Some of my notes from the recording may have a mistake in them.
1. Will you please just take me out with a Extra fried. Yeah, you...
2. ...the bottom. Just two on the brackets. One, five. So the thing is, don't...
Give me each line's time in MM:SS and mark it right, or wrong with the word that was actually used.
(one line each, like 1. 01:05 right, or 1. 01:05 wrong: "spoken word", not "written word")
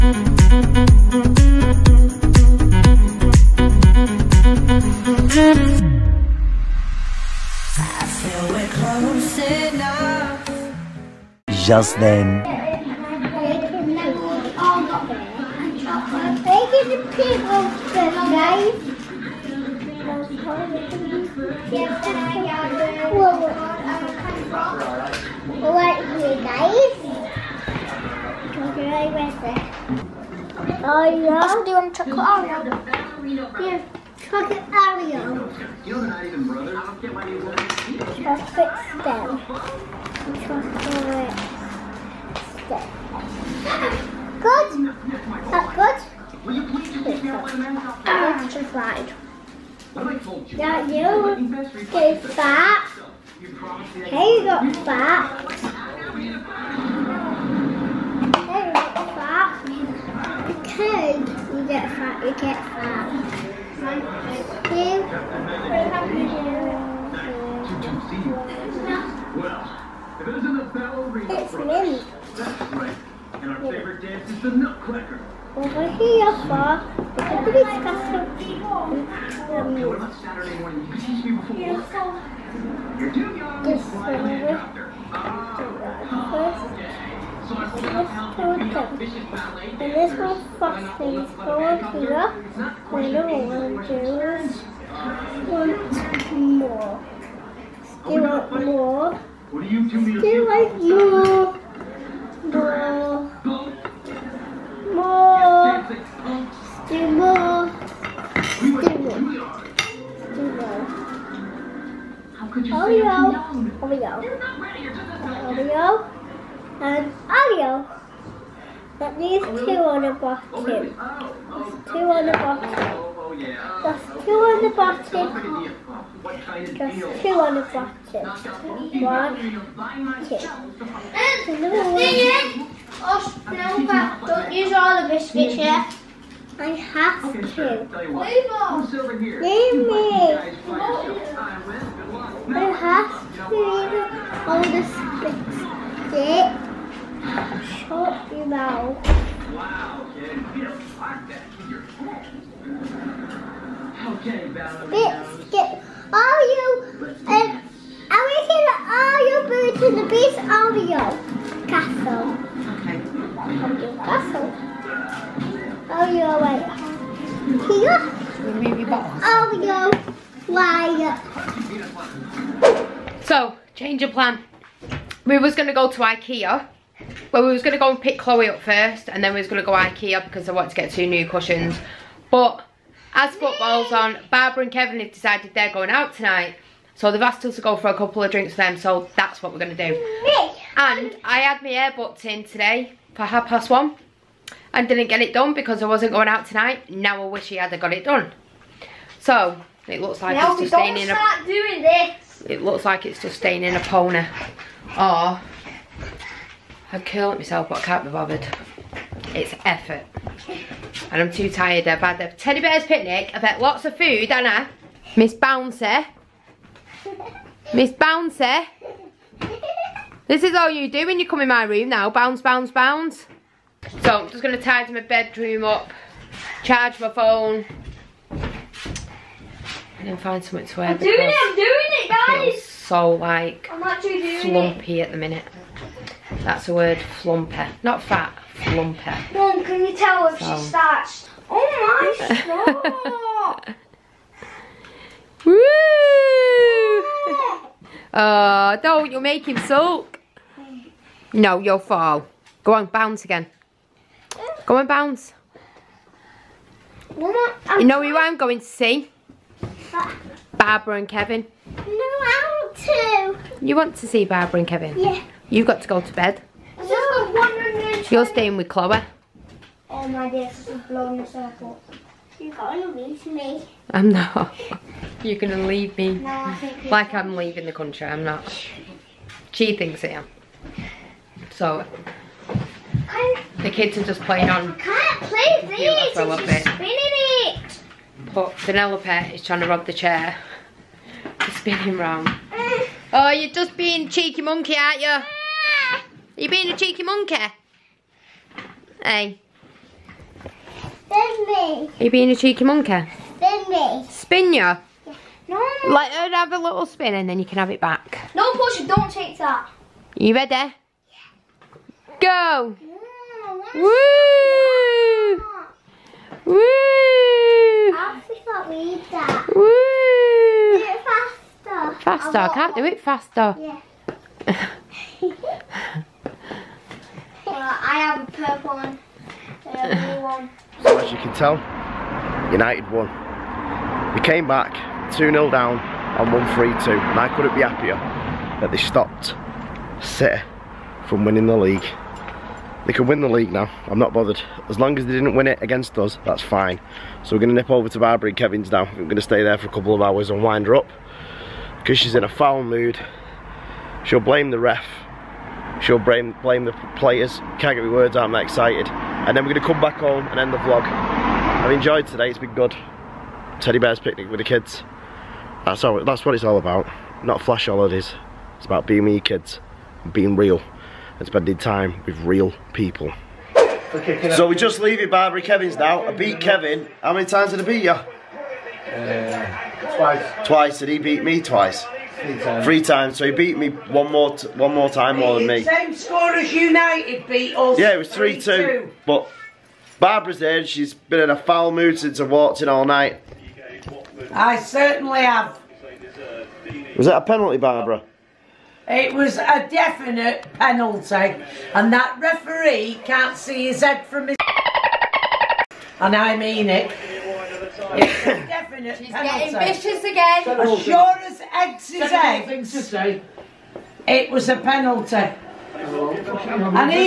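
1. 00:46 right
2. 02:04 wrong: "two", not "five".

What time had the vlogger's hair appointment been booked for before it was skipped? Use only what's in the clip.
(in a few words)
half past one.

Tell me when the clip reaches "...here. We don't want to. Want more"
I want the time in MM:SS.
01:31.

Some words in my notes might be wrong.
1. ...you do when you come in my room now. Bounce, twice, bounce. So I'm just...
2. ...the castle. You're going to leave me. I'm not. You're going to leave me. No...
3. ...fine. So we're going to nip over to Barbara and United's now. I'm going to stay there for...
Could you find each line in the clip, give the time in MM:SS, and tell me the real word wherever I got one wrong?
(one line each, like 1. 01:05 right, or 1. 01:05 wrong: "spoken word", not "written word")
1. 03:40 wrong: "bounce", not "twice"
2. 04:31 wrong: "circle", not "castle"
3. 05:46 wrong: "Kevin", not "United".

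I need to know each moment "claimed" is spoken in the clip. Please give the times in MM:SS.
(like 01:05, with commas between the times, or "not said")
not said.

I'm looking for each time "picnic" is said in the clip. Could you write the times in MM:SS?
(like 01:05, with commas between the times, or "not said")
03:32, 06:03.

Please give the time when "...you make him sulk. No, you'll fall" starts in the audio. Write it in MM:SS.
04:09.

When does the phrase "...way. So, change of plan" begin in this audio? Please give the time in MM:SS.
02:52.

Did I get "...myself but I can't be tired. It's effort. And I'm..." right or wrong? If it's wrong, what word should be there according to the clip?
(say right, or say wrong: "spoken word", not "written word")
wrong: "bothered", not "tired".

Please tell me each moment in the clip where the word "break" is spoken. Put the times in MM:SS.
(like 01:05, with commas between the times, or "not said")
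not said.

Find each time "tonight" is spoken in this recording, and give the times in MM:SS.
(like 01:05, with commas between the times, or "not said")
03:06, 03:16.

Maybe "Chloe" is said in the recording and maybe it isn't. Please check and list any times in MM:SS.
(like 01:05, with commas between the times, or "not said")
02:58, 04:28.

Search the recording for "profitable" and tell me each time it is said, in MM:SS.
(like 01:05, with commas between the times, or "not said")
not said.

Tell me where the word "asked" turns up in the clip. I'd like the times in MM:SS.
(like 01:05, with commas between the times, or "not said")
03:07.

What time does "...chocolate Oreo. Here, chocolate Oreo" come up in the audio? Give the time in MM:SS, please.
00:31.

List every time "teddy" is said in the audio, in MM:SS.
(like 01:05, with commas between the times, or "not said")
03:32, 06:03.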